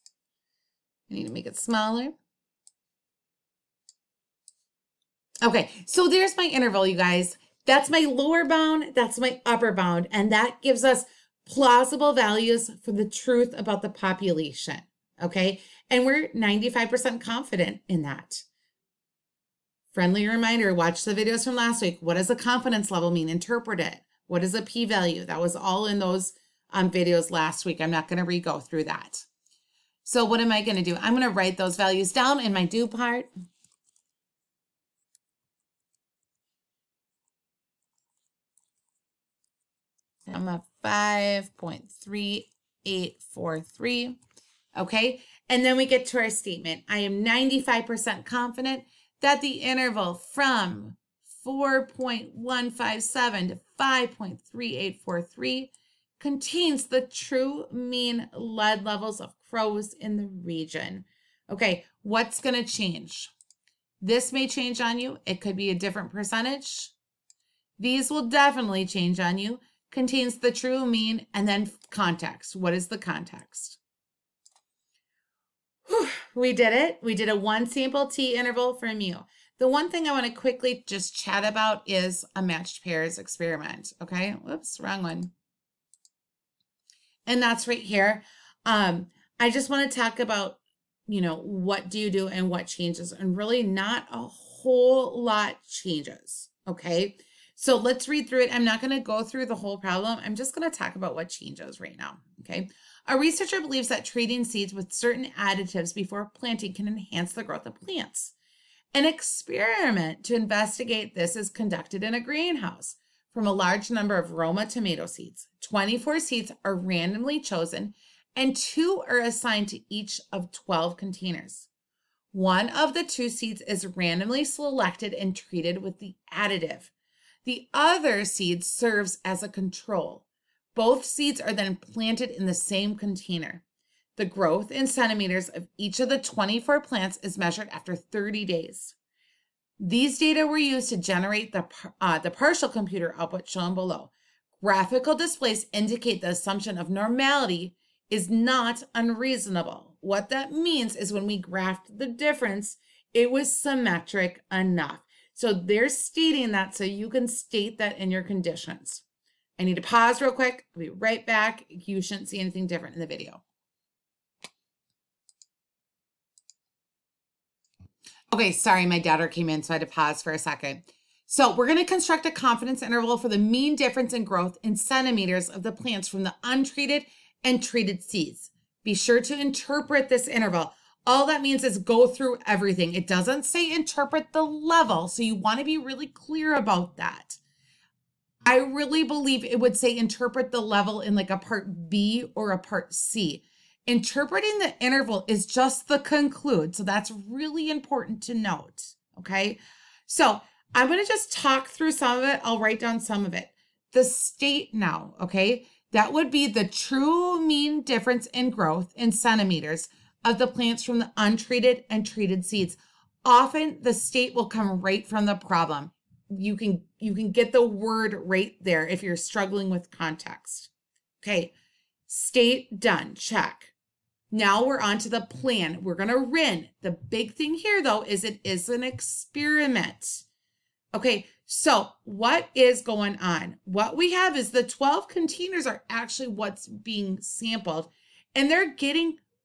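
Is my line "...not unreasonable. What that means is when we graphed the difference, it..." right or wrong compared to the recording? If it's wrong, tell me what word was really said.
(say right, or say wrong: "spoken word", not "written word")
right.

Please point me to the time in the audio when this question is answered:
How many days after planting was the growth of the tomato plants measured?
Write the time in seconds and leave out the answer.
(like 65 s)
137 s.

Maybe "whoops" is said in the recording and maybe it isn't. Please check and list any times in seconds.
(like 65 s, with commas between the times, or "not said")
84 s.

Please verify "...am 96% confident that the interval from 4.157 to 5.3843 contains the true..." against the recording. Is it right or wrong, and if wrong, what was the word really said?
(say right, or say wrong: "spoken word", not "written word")
wrong: "95", not "96".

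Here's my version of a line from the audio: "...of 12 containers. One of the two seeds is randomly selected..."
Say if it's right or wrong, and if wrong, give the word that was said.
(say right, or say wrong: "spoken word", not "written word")
right.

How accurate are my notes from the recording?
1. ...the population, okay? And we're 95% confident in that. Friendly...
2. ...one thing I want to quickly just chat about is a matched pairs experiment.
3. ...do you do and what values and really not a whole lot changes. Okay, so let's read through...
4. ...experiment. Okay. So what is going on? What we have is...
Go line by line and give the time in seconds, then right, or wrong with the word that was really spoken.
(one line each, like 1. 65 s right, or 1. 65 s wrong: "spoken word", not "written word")
1. 13 s right
2. 79 s right
3. 91 s wrong: "changes", not "values"
4. 228 s right.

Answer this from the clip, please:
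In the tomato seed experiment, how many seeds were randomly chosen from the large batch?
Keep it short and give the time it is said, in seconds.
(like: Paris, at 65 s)
24, at 115 s.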